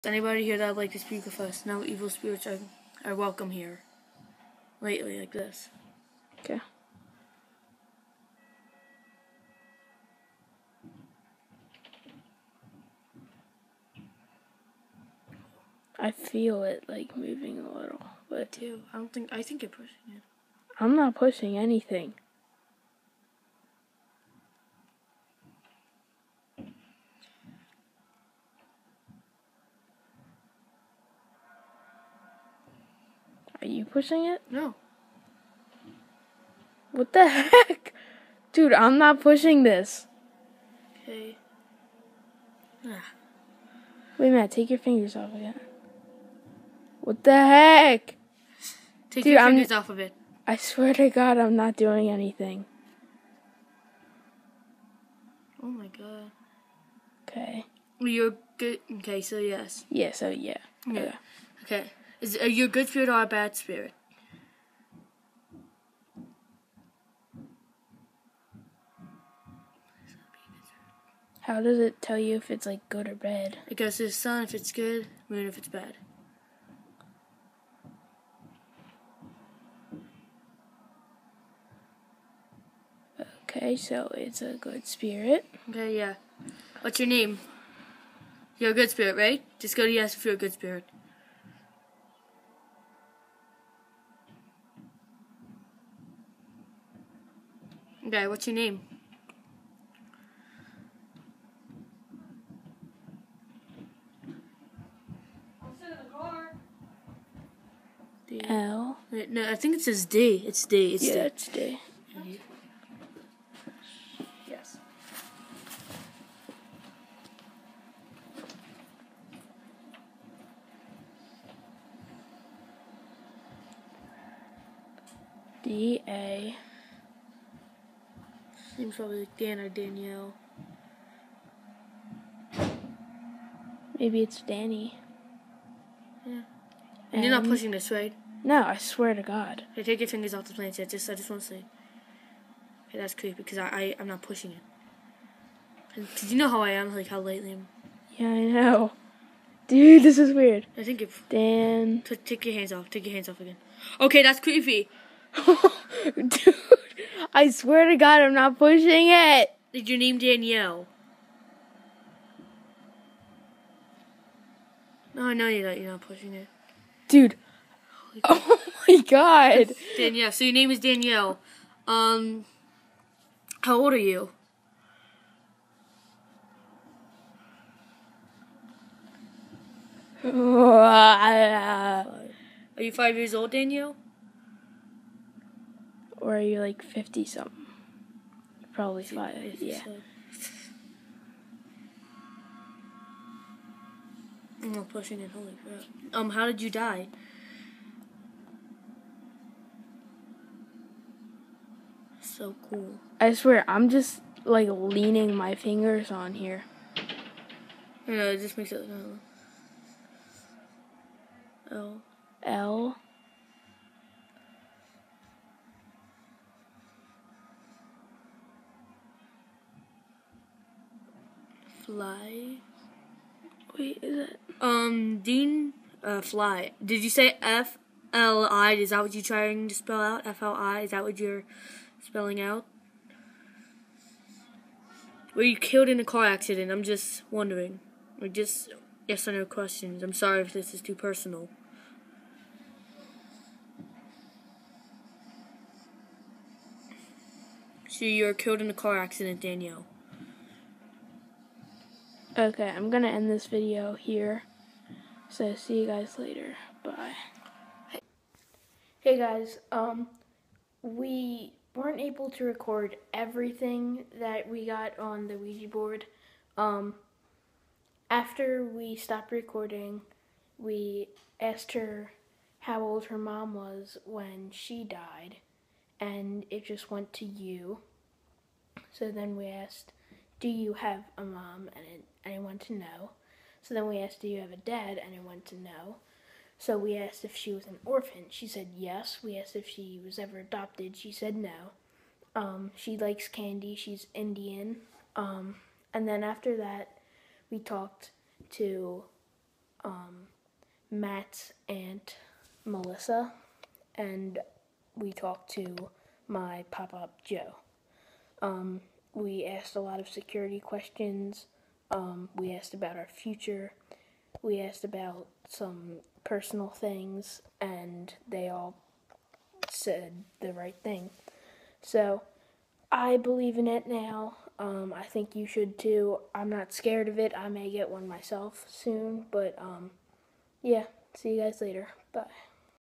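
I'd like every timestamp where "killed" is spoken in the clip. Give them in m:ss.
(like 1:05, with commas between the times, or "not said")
3:55, 4:08.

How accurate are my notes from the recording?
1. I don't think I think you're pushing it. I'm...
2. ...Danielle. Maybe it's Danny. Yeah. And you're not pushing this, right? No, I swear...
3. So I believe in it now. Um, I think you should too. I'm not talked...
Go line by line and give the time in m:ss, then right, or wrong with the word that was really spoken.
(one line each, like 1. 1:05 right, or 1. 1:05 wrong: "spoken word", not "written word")
1. 0:18 right
2. 2:09 right
3. 5:21 wrong: "scared", not "talked".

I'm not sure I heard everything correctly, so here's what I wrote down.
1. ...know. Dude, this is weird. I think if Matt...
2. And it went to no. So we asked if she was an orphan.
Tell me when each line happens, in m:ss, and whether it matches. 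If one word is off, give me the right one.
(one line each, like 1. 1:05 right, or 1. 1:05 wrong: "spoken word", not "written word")
1. 2:28 wrong: "Dan", not "Matt"
2. 4:45 right.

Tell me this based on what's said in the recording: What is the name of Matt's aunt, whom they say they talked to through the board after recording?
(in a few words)
Melissa.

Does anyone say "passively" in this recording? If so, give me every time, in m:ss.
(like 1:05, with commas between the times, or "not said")
not said.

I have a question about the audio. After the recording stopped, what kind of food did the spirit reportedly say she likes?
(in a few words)
Candy.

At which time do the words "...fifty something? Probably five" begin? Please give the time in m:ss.
3:06.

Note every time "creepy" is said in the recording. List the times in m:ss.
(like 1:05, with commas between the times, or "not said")
2:23, 2:34.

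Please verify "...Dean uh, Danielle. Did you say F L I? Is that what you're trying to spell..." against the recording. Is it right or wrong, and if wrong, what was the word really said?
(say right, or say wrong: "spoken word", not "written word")
wrong: "Fly", not "Danielle".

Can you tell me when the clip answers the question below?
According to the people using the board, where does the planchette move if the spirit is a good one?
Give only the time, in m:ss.
1:14.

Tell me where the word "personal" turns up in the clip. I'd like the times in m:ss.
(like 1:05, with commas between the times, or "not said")
4:00, 5:16.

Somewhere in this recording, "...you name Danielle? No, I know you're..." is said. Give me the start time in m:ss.
2:39.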